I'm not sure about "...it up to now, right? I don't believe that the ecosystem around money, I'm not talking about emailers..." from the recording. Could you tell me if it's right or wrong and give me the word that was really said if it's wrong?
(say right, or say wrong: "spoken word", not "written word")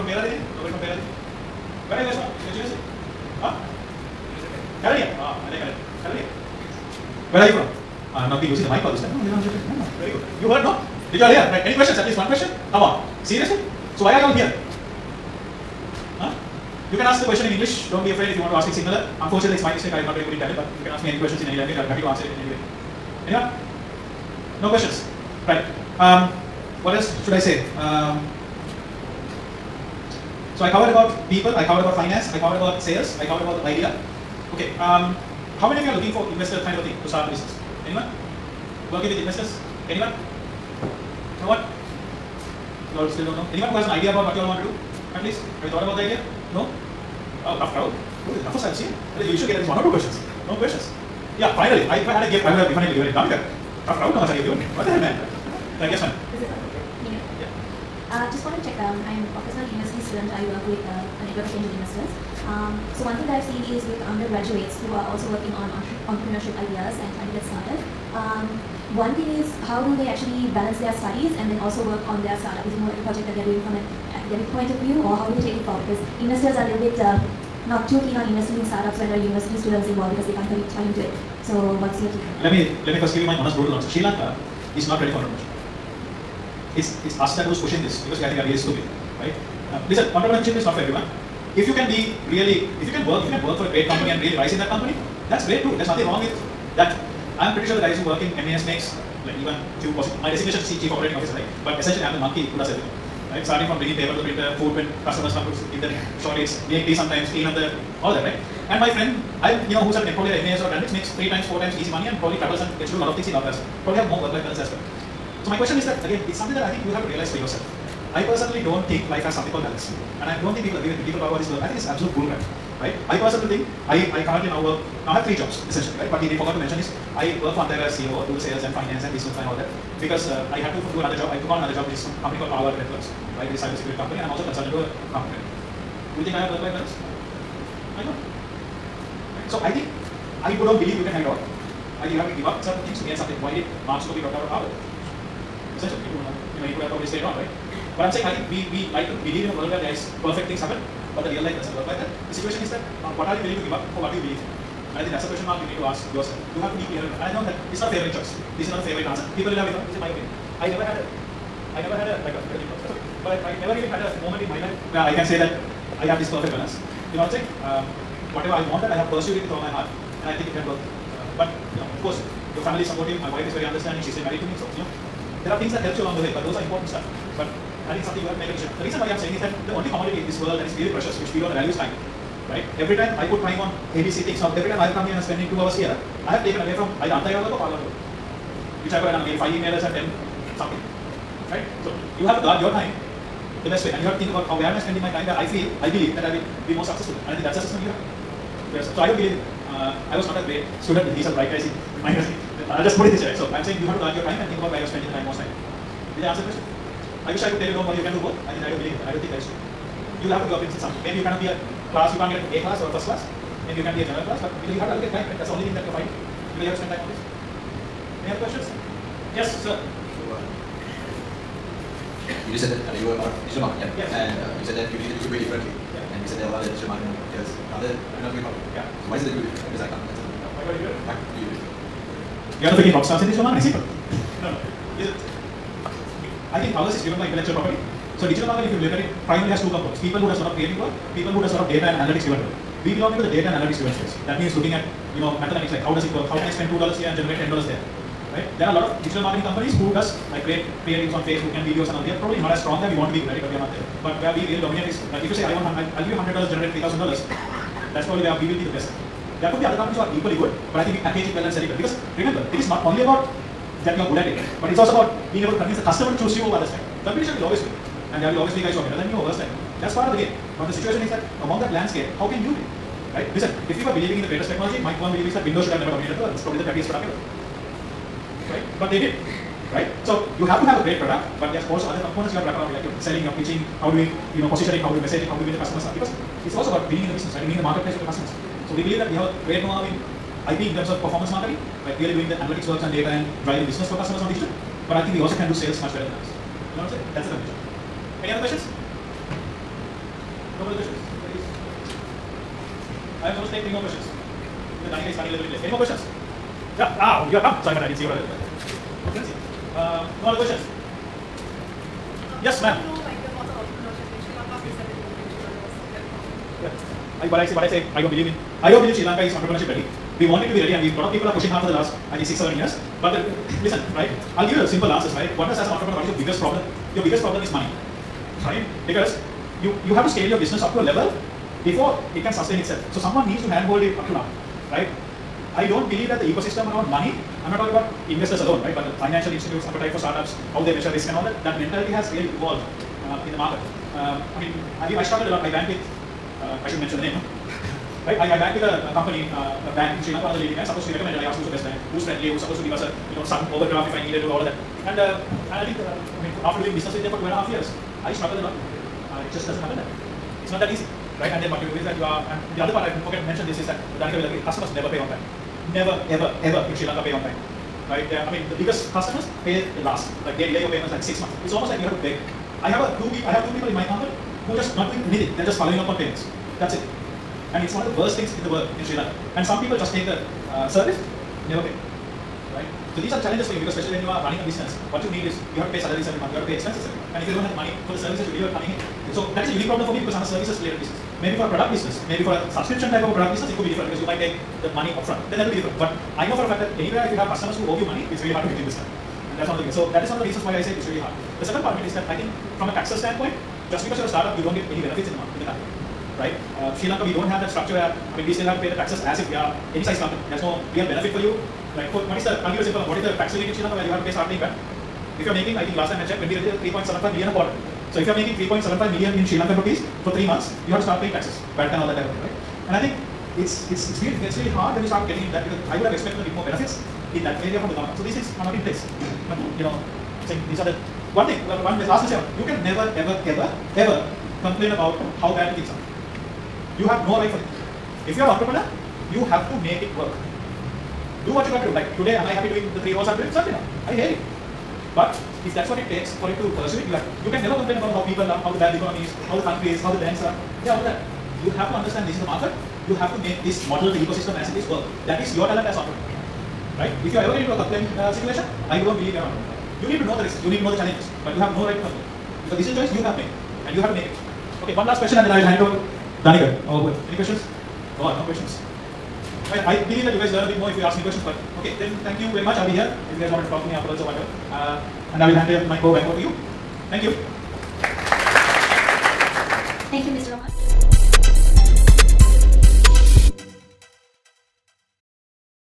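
wrong: "investors", not "emailers".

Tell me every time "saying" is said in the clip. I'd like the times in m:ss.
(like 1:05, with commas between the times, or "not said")
2:28, 2:47, 2:59, 3:23, 4:56, 7:10.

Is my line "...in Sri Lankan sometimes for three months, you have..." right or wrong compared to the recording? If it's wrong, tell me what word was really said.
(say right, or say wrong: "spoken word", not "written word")
wrong: "rupees", not "sometimes".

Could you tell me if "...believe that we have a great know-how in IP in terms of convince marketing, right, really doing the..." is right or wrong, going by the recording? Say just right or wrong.
wrong.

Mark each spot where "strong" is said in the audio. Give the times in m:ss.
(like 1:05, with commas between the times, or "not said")
4:12.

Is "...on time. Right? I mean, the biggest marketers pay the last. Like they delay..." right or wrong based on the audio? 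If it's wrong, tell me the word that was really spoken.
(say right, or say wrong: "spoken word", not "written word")
wrong: "customers", not "marketers".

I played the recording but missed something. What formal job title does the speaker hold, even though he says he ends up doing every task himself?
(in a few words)
Chief operating officer.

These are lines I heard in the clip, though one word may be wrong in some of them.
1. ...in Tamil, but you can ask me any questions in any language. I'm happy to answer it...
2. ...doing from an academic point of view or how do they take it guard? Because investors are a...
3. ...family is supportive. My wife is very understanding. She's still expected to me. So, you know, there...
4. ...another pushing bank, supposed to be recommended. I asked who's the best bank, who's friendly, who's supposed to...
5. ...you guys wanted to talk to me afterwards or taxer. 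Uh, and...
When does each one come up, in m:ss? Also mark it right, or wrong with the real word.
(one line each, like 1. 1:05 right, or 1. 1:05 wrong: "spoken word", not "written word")
1. 0:20 right
2. 1:13 wrong: "forward", not "guard"
3. 2:52 wrong: "married", not "expected"
4. 5:50 wrong: "leading", not "pushing"
5. 7:53 wrong: "whatever", not "taxer".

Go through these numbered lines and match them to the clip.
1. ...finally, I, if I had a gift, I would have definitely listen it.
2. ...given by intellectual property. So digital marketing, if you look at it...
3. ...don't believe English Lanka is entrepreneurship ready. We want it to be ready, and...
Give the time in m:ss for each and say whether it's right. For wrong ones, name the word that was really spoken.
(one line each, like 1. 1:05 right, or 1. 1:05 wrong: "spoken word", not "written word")
1. 0:51 wrong: "given", not "listen"
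2. 3:57 wrong: "driven", not "given"
3. 5:18 wrong: "Sri", not "English".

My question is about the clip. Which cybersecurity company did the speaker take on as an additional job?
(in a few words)
Palo Alto Networks.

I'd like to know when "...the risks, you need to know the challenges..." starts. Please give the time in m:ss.
7:40.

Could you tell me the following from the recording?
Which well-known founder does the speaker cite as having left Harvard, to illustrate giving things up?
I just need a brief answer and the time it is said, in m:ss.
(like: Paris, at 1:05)
Mark Zuckerberg, at 2:23.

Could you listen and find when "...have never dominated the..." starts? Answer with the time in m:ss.
4:35.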